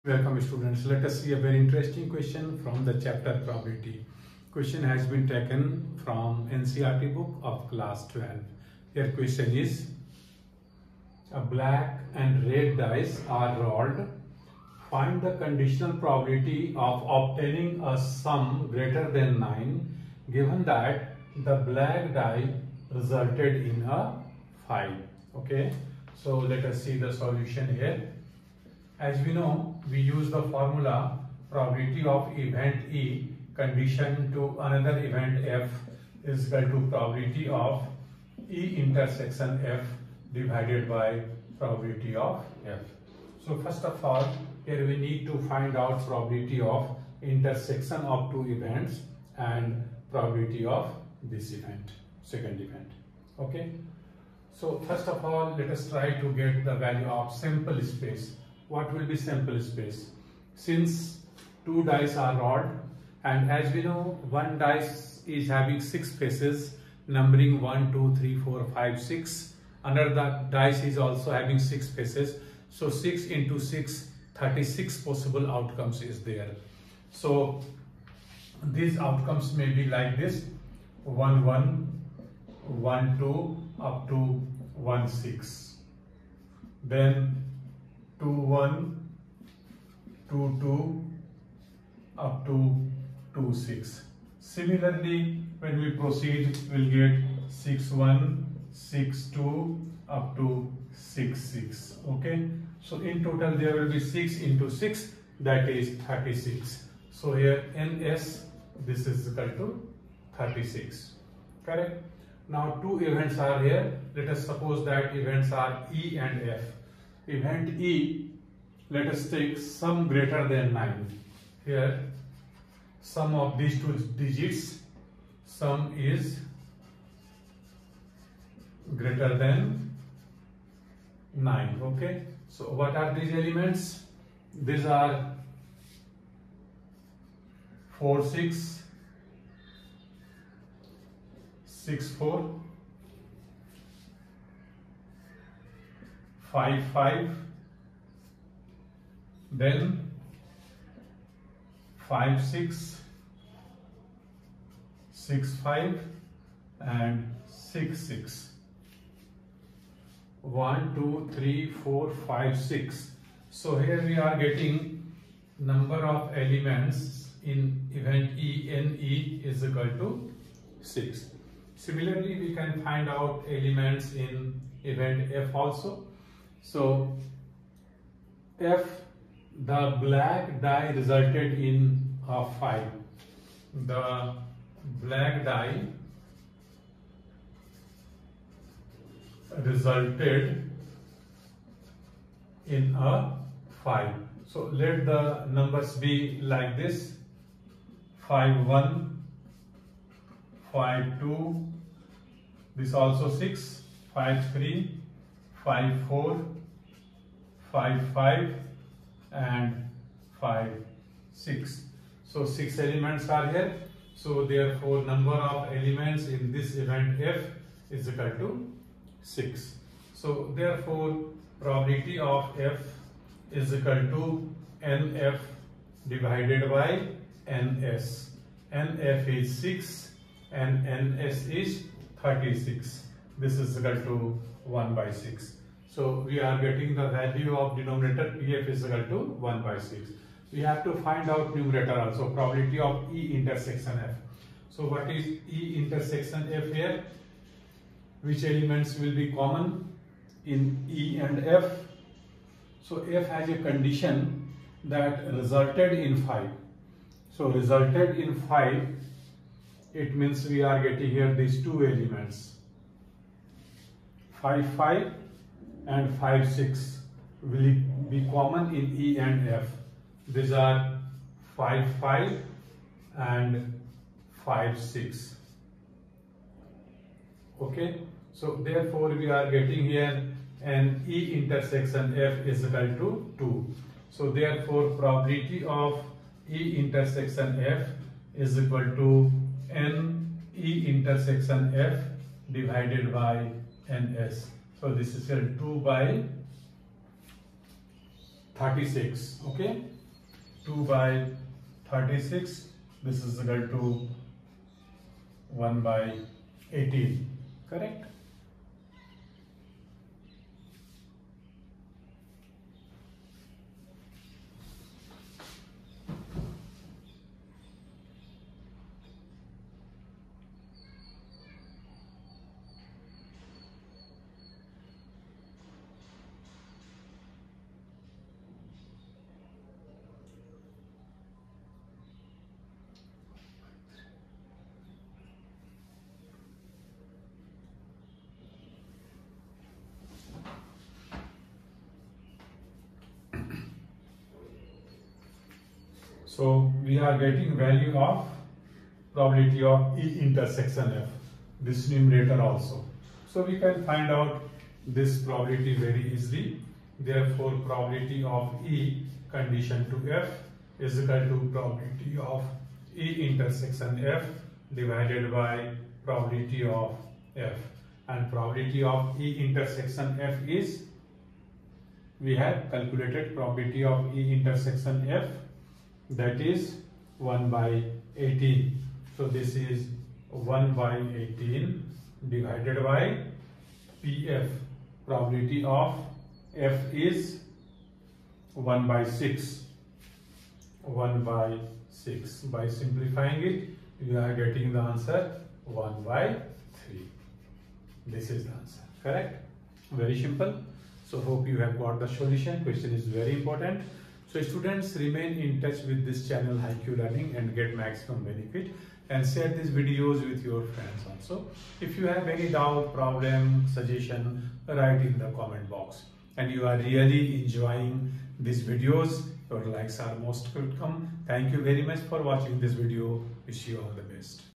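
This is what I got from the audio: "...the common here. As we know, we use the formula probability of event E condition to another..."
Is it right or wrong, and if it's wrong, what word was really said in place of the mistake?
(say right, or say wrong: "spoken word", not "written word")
wrong: "solution", not "common".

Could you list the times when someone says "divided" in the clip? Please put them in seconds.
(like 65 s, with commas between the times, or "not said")
40 s, 226 s, 292 s, 364 s, 382 s.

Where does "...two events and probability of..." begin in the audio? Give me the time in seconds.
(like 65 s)
48 s.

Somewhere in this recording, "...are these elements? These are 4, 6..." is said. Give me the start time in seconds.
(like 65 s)
132 s.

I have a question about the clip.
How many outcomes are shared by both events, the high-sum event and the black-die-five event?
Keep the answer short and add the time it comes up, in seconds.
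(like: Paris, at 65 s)
2, at 280 s.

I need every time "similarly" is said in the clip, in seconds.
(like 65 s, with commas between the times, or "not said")
94 s, 171 s.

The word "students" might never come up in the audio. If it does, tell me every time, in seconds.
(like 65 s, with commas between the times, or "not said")
0 s, 404 s.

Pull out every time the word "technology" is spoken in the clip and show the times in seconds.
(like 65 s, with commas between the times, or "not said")
not said.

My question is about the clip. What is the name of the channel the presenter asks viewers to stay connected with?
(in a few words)
Hi-Q Learning.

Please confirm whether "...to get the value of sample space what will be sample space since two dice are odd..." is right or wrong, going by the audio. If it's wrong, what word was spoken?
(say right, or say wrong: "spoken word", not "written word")
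right.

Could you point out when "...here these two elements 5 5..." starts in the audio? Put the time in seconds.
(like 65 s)
261 s.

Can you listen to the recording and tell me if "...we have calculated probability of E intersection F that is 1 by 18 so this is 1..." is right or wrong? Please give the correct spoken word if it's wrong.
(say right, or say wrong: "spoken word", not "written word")
right.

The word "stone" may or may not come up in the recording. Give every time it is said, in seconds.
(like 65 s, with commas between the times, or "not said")
not said.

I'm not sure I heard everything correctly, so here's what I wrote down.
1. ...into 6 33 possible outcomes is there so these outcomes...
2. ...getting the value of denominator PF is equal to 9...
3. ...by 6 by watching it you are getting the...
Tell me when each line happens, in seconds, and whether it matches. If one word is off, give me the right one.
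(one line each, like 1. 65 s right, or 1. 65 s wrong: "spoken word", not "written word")
1. 73 s wrong: "36", not "33"
2. 236 s wrong: "1", not "9"
3. 391 s wrong: "simplifying", not "watching".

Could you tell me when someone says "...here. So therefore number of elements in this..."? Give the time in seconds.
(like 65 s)
213 s.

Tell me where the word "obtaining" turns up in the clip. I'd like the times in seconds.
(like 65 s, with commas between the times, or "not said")
17 s.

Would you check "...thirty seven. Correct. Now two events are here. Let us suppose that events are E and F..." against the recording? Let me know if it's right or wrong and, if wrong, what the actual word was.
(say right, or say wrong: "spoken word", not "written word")
wrong: "six", not "seven".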